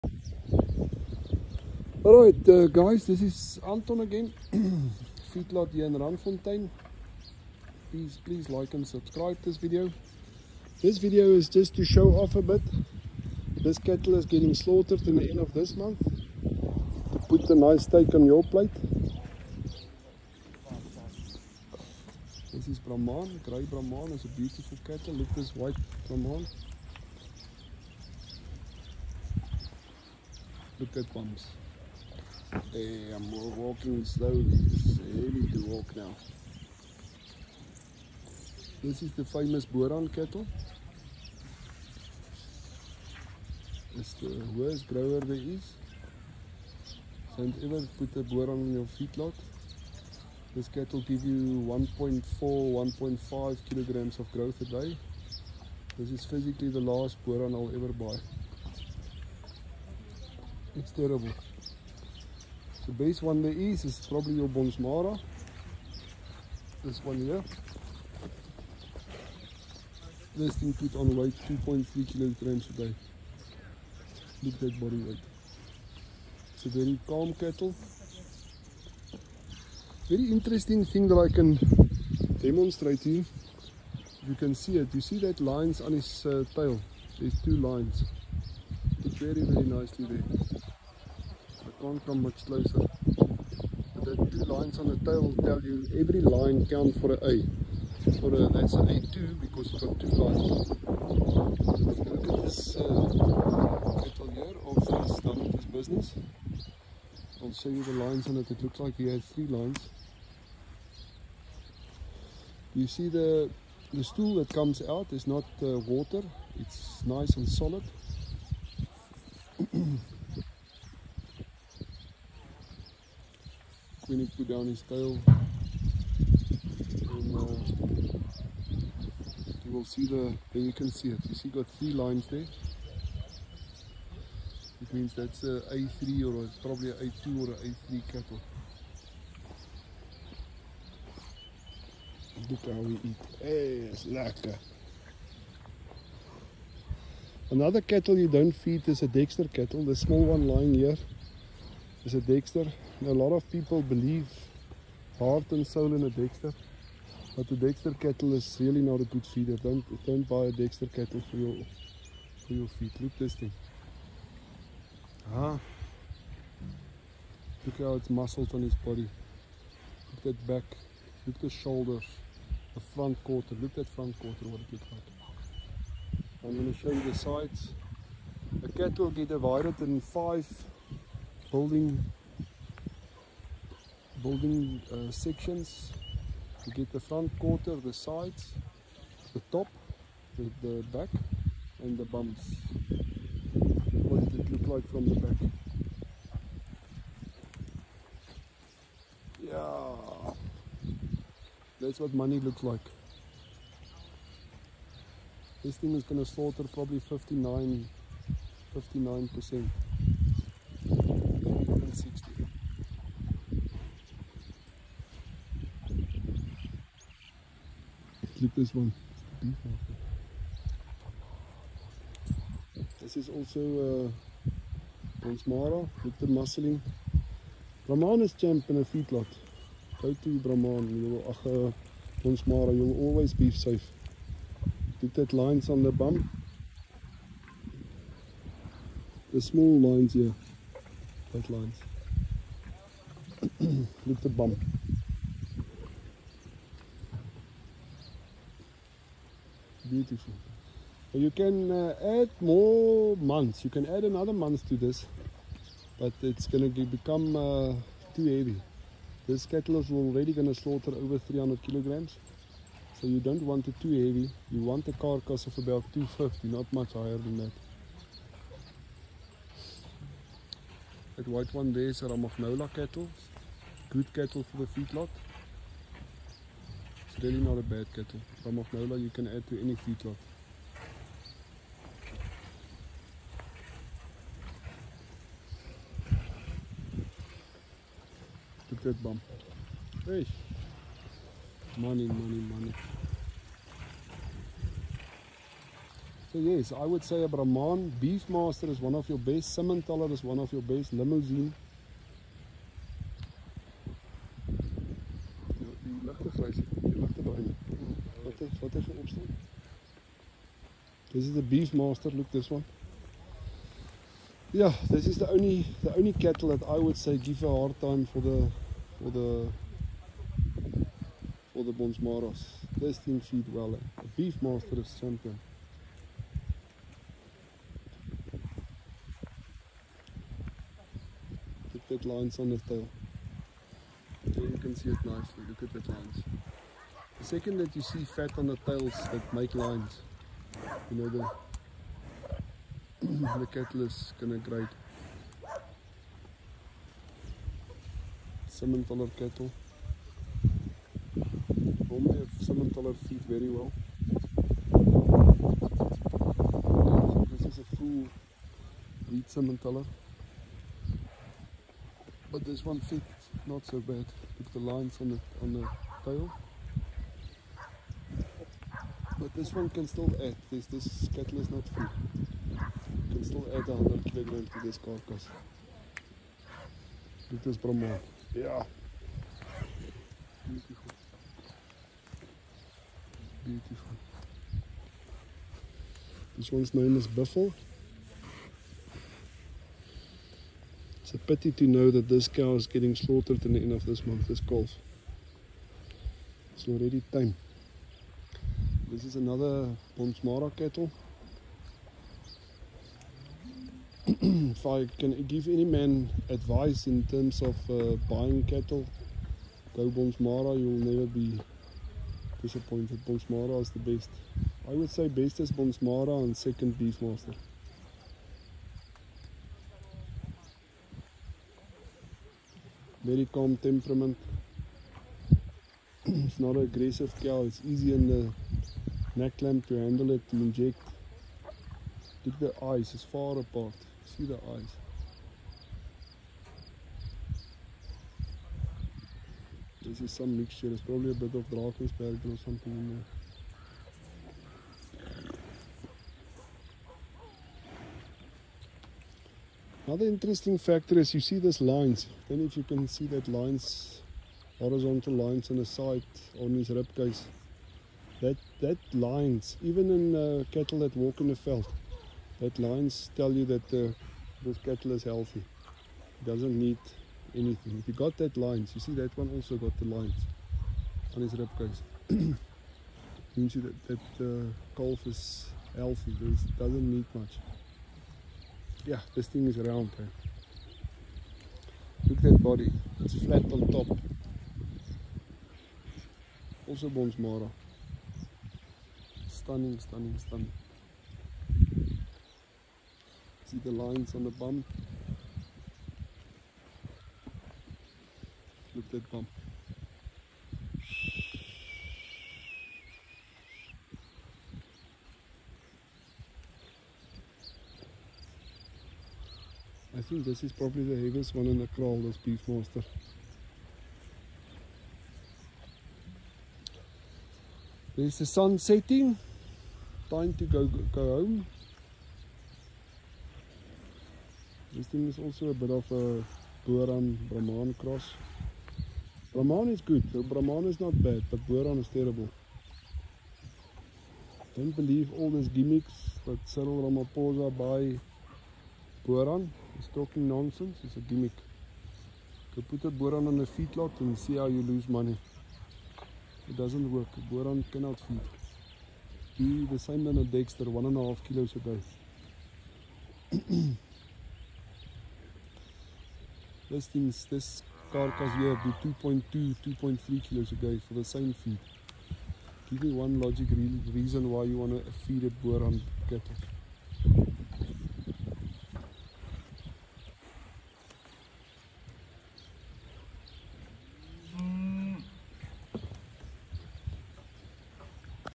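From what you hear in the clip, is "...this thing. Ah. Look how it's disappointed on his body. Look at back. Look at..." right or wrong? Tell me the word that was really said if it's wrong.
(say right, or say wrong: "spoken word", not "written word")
wrong: "muscled", not "disappointed".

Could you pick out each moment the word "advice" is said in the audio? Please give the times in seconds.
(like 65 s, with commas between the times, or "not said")
406 s.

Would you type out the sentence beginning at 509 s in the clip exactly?
I think this is probably the heaviest one in the kraal, this monster.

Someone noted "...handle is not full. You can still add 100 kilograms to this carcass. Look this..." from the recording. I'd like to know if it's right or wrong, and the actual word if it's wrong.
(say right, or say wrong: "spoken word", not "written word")
wrong: "kettle", not "handle".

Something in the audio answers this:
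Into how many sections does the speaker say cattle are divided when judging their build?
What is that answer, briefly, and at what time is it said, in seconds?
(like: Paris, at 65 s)
5, at 180 s.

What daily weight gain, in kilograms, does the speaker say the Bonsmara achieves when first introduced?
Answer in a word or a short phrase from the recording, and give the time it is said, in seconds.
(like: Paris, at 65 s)
2.3 kilograms, at 71 s.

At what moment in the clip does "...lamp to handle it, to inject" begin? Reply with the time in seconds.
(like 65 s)
429 s.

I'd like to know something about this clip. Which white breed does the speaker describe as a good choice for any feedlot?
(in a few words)
Romagnola.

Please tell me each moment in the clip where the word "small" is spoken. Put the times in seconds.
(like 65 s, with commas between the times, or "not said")
149 s, 239 s.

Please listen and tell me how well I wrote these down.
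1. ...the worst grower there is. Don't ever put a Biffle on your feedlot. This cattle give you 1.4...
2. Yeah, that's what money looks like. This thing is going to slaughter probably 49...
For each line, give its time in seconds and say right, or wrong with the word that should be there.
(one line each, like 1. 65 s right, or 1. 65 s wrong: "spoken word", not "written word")
1. 44 s wrong: "Boran", not "Biffle"
2. 199 s wrong: "59", not "49".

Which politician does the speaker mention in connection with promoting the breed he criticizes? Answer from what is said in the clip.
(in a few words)
Cyril Ramaphosa.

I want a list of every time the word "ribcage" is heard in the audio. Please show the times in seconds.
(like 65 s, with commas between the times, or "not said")
456 s, 471 s.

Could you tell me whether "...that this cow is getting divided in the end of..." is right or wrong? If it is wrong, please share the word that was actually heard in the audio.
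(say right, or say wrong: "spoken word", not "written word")
wrong: "slaughtered", not "divided".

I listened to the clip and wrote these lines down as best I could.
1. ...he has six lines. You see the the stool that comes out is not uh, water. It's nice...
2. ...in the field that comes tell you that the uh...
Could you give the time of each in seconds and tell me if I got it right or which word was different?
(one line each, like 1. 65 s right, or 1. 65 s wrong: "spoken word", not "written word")
1. 108 s wrong: "three", not "six"
2. 461 s wrong: "lines", not "comes".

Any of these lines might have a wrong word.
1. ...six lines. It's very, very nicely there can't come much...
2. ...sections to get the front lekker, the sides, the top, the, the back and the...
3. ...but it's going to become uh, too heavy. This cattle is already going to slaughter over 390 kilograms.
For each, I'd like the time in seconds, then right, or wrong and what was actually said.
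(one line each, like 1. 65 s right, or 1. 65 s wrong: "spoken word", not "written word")
1. 87 s wrong: "two", not "six"
2. 185 s wrong: "quarter", not "lekker"
3. 255 s wrong: "300", not "390".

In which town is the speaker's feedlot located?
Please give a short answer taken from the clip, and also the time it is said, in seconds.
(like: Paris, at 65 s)
Randfontein, at 5 s.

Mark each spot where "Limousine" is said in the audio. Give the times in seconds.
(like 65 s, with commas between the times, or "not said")
300 s.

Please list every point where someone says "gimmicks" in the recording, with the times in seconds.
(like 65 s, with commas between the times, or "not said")
535 s, 541 s.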